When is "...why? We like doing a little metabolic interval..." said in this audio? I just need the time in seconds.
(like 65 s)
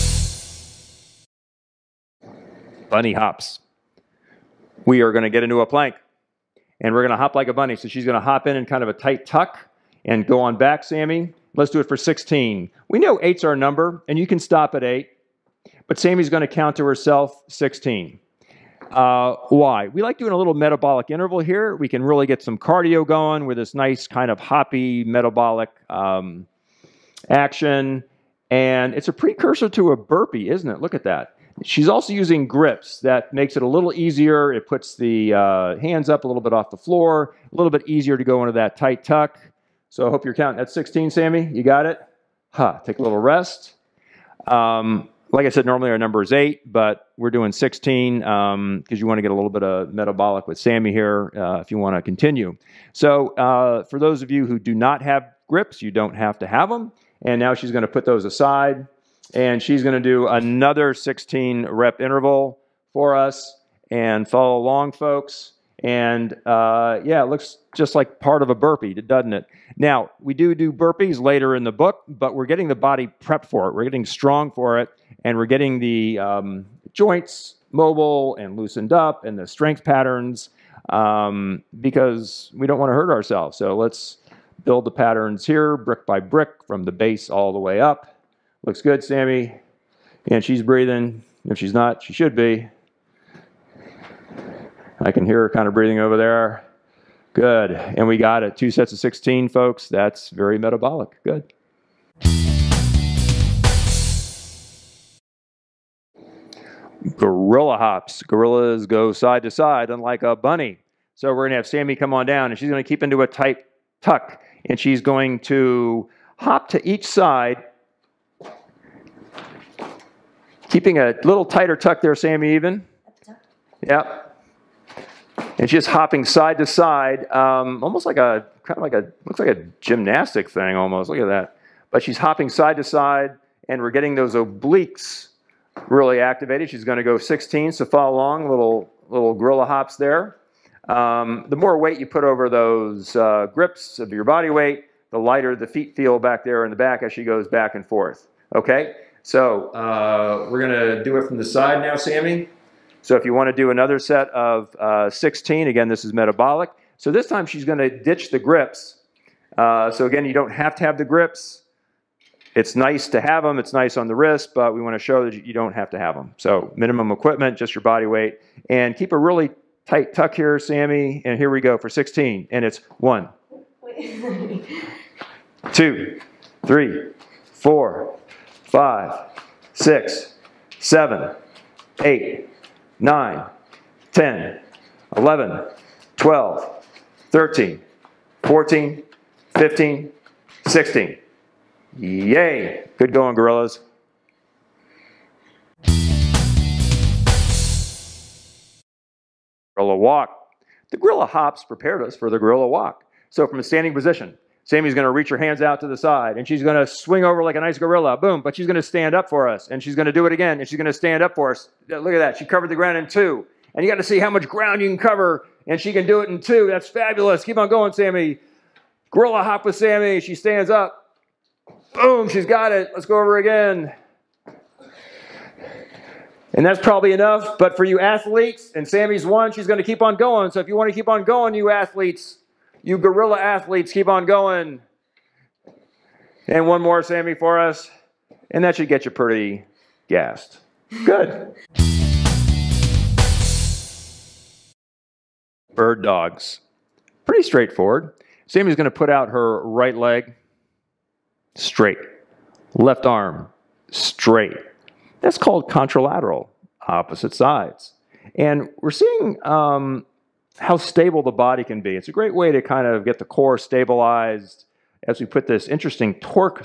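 19 s.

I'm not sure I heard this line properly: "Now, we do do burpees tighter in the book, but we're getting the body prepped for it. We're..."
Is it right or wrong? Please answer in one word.
wrong.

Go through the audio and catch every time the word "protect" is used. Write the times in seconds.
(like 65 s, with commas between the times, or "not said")
not said.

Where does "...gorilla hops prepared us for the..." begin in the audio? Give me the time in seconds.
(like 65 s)
200 s.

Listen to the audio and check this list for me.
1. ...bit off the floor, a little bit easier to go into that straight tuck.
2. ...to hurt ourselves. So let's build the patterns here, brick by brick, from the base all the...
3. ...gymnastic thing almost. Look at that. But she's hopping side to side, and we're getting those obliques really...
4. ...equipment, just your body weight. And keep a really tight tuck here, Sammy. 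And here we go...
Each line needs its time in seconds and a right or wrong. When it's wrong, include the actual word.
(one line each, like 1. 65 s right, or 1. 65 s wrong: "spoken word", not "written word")
1. 36 s wrong: "tight", not "straight"
2. 82 s right
3. 129 s right
4. 167 s right.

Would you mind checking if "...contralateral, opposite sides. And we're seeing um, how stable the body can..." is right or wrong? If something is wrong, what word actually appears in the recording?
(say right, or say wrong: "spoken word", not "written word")
right.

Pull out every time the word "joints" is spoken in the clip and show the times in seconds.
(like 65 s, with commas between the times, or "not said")
76 s.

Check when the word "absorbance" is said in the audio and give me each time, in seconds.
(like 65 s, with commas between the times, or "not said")
not said.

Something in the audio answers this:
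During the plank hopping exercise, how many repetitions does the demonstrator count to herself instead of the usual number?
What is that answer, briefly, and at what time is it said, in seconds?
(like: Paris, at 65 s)
16, at 15 s.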